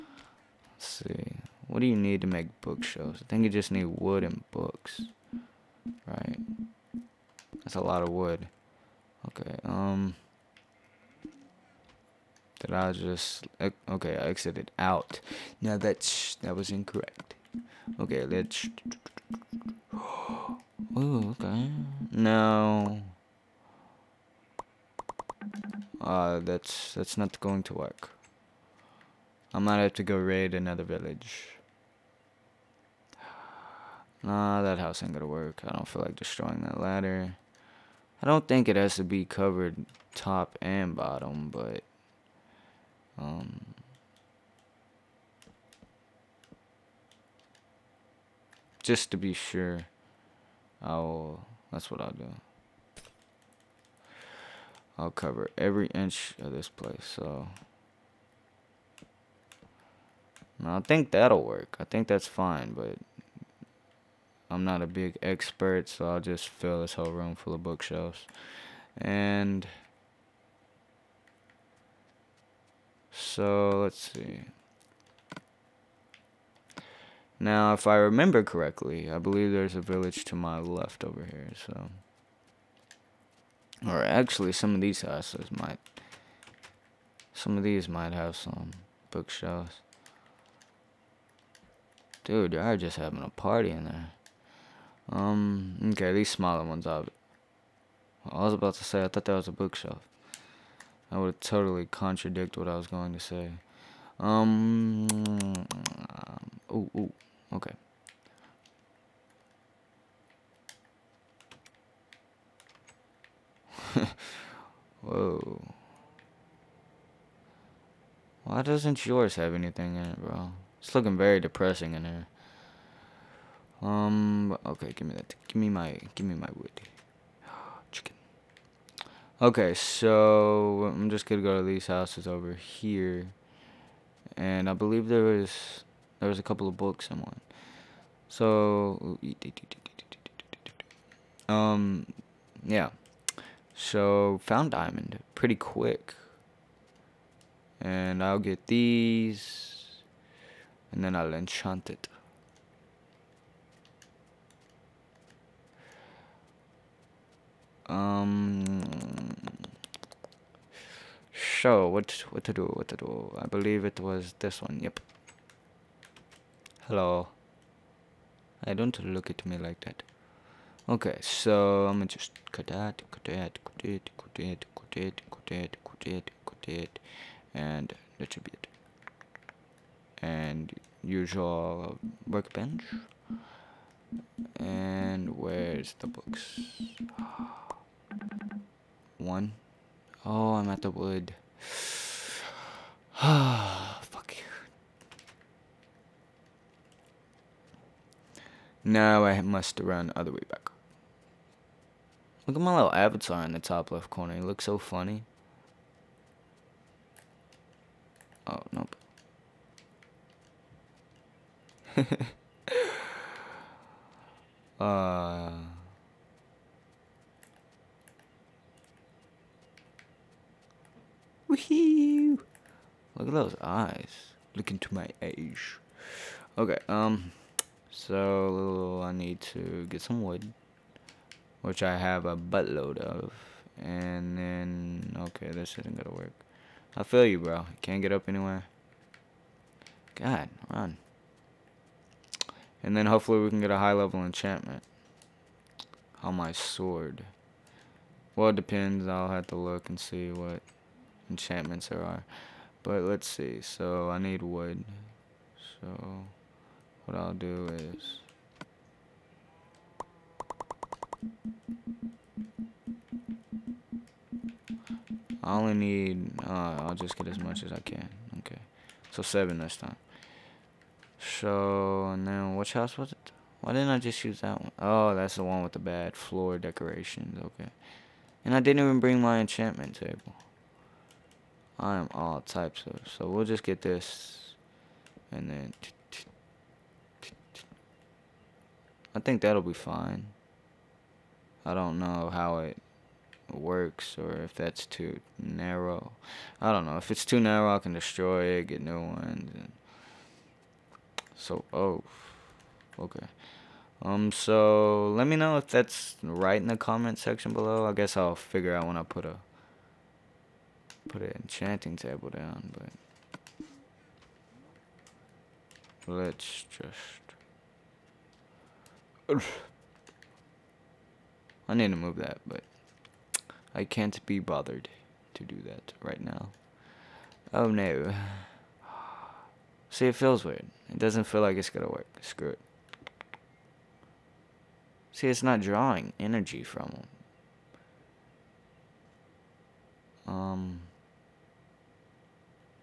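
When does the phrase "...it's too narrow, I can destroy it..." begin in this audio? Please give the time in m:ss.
4:57.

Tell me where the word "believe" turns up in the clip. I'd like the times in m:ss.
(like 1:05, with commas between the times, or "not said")
1:19, 2:14, 2:43.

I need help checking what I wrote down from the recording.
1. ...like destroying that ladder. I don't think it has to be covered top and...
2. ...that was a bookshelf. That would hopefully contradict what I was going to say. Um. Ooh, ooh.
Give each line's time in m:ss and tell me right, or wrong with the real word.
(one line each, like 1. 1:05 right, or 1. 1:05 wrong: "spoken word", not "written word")
1. 0:36 right
2. 1:39 wrong: "totally", not "hopefully".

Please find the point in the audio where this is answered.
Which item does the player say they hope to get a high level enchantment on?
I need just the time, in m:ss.
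4:06.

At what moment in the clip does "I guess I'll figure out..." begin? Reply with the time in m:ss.
5:07.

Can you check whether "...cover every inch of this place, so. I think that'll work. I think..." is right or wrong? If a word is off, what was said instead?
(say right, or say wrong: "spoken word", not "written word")
right.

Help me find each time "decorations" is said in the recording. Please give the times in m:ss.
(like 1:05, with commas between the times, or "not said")
4:36.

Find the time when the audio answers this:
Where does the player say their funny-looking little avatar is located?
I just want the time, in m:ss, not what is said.
3:23.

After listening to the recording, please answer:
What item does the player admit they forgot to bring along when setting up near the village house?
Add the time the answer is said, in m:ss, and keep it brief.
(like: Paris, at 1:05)
enchantment table, at 4:39.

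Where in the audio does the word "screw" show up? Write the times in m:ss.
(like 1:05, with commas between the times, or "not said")
5:32.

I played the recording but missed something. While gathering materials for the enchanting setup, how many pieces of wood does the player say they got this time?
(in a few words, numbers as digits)
7.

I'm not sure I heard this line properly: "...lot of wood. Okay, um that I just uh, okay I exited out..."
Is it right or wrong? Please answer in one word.
right.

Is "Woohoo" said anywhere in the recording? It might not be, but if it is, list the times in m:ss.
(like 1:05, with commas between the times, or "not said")
3:41.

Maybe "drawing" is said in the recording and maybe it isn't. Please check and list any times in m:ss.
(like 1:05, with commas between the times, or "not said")
5:35.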